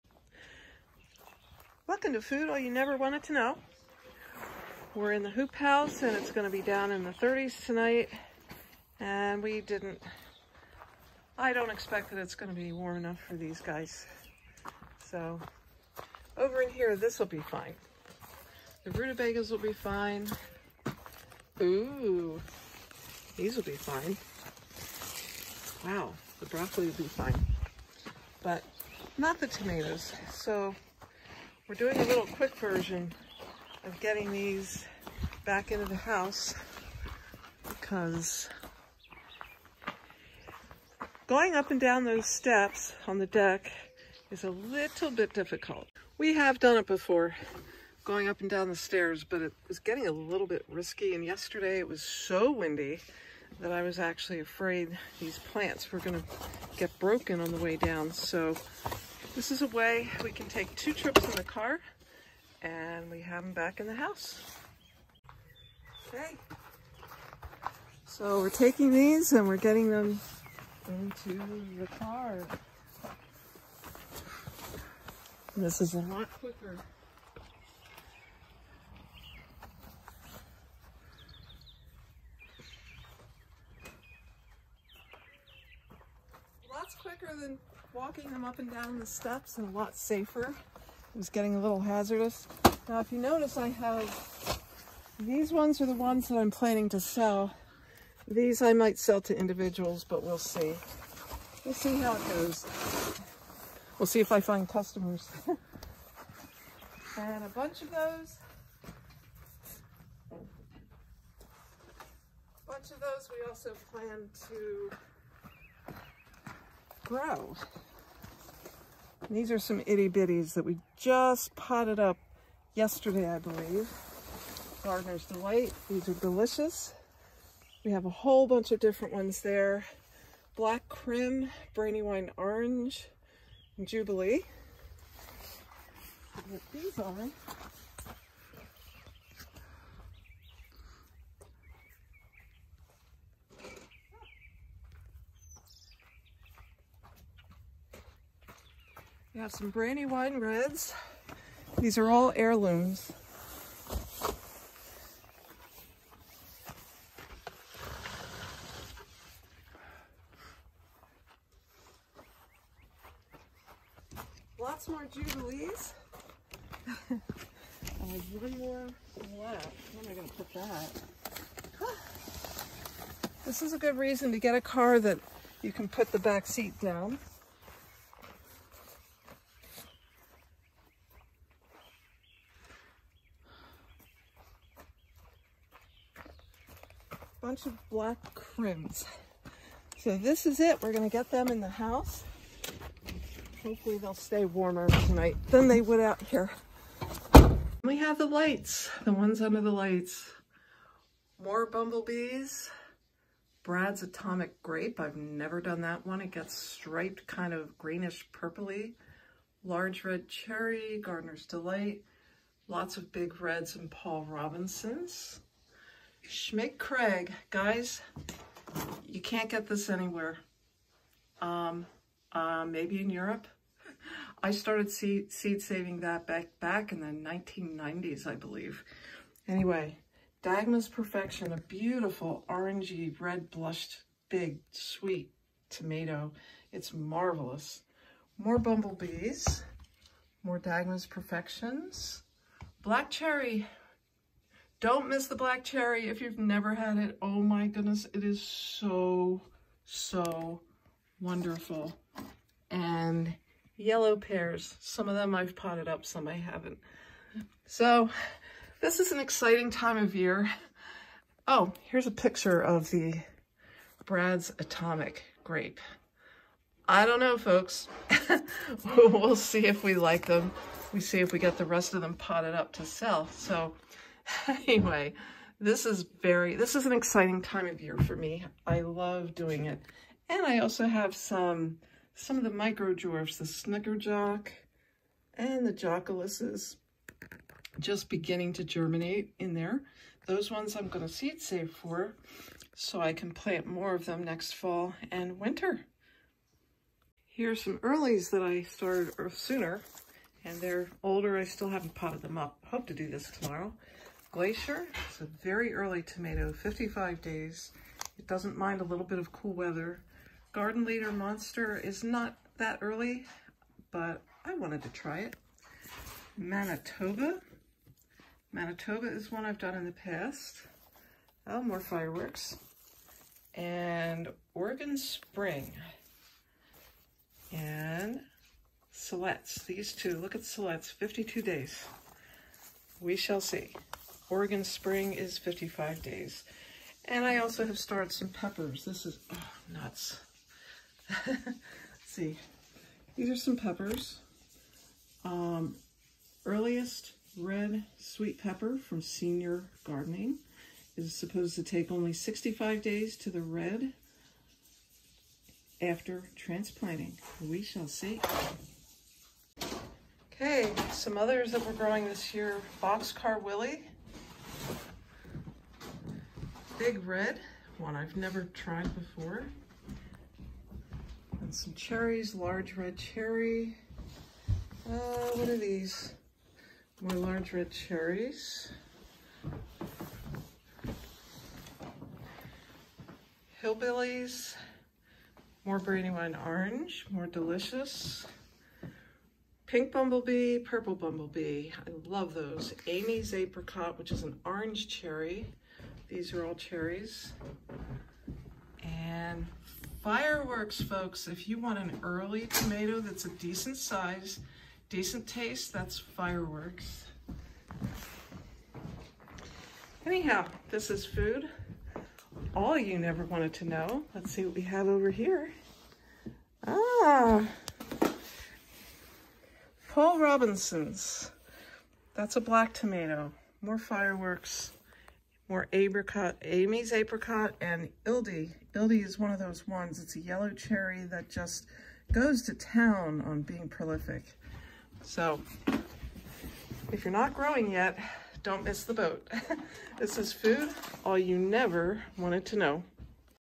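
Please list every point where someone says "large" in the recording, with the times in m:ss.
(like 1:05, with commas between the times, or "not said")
3:29, 6:12, 6:17.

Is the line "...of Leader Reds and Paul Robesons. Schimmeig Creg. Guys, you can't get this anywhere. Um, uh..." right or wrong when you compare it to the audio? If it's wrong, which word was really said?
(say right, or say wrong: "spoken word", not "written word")
wrong: "Big", not "Leader".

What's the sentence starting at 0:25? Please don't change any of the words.
Wow, the broccoli will be fine.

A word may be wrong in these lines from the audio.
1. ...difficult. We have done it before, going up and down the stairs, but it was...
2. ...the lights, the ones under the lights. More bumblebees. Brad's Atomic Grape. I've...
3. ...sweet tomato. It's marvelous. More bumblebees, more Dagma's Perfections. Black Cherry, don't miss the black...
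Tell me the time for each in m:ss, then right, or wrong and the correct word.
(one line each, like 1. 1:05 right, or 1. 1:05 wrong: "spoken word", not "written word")
1. 0:45 right
2. 3:18 right
3. 3:54 right.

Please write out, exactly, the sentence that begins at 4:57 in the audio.
Here's some earlies that I started sooner and they're older.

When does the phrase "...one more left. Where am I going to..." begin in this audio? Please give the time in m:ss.
2:48.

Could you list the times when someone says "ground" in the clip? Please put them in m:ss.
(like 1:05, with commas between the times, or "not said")
not said.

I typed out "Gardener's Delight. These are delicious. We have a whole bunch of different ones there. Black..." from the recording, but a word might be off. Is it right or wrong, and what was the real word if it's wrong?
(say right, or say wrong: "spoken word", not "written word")
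right.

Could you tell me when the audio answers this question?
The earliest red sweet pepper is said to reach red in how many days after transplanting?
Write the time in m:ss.
5:52.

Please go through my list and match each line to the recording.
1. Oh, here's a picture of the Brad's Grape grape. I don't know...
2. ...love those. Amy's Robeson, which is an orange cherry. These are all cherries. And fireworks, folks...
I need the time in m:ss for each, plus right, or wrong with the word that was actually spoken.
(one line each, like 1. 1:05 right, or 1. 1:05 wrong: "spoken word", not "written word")
1. 4:21 wrong: "Atomic", not "Grape"
2. 6:32 wrong: "Apricot", not "Robeson".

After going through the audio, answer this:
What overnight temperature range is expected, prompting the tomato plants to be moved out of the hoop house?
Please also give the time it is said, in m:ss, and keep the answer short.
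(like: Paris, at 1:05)
30s, at 0:07.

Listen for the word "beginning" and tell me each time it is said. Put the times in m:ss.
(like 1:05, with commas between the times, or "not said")
4:48.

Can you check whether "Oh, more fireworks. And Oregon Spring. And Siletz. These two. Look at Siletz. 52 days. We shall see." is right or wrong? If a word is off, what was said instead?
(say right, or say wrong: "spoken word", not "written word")
right.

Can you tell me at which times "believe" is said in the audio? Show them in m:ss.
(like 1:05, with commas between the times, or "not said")
2:03, 3:48.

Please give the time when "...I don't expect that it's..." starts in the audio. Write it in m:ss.
0:11.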